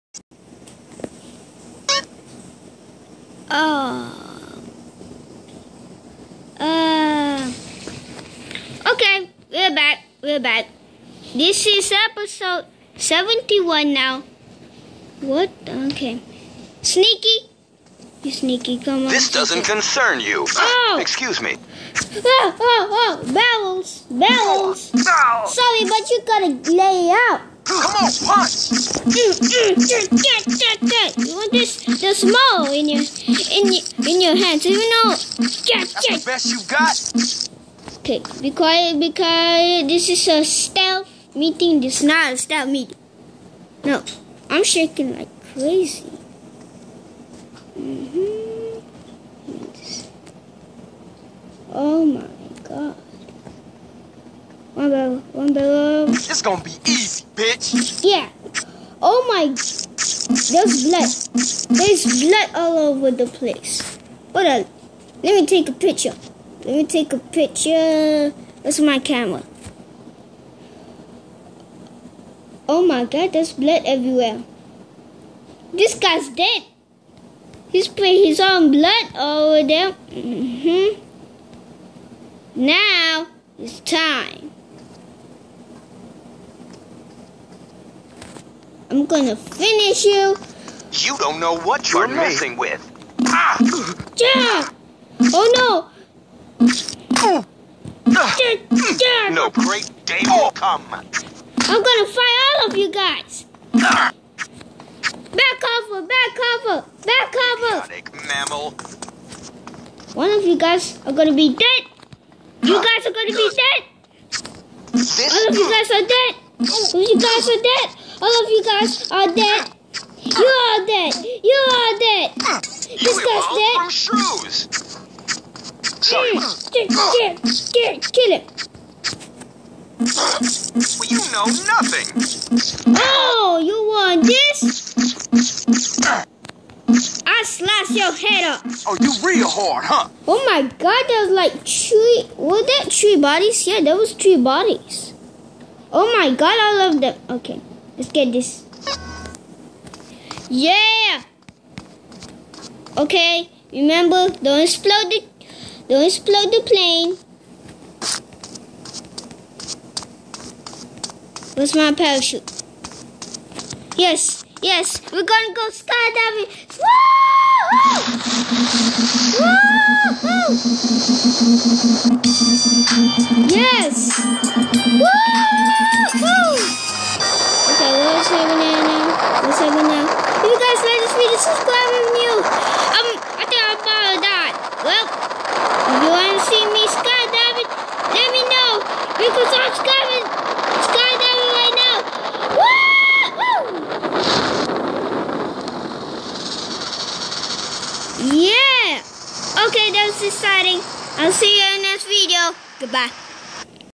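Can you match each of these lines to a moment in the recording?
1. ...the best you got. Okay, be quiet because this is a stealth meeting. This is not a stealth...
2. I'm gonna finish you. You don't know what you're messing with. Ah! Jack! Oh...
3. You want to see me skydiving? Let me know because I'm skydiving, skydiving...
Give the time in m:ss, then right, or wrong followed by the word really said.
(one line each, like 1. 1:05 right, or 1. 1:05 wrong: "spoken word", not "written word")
1. 0:36 right
2. 1:28 right
3. 3:05 right.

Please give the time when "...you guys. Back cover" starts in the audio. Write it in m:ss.
1:42.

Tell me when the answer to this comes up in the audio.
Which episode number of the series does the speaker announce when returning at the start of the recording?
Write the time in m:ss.
0:12.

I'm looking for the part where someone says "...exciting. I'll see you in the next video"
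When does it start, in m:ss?
3:20.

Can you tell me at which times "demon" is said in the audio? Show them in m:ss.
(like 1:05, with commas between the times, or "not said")
not said.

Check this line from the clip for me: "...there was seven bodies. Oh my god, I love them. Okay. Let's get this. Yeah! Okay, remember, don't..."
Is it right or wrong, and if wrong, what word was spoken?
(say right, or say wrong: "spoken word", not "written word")
wrong: "three", not "seven".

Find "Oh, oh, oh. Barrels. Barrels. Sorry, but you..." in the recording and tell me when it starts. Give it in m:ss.
0:22.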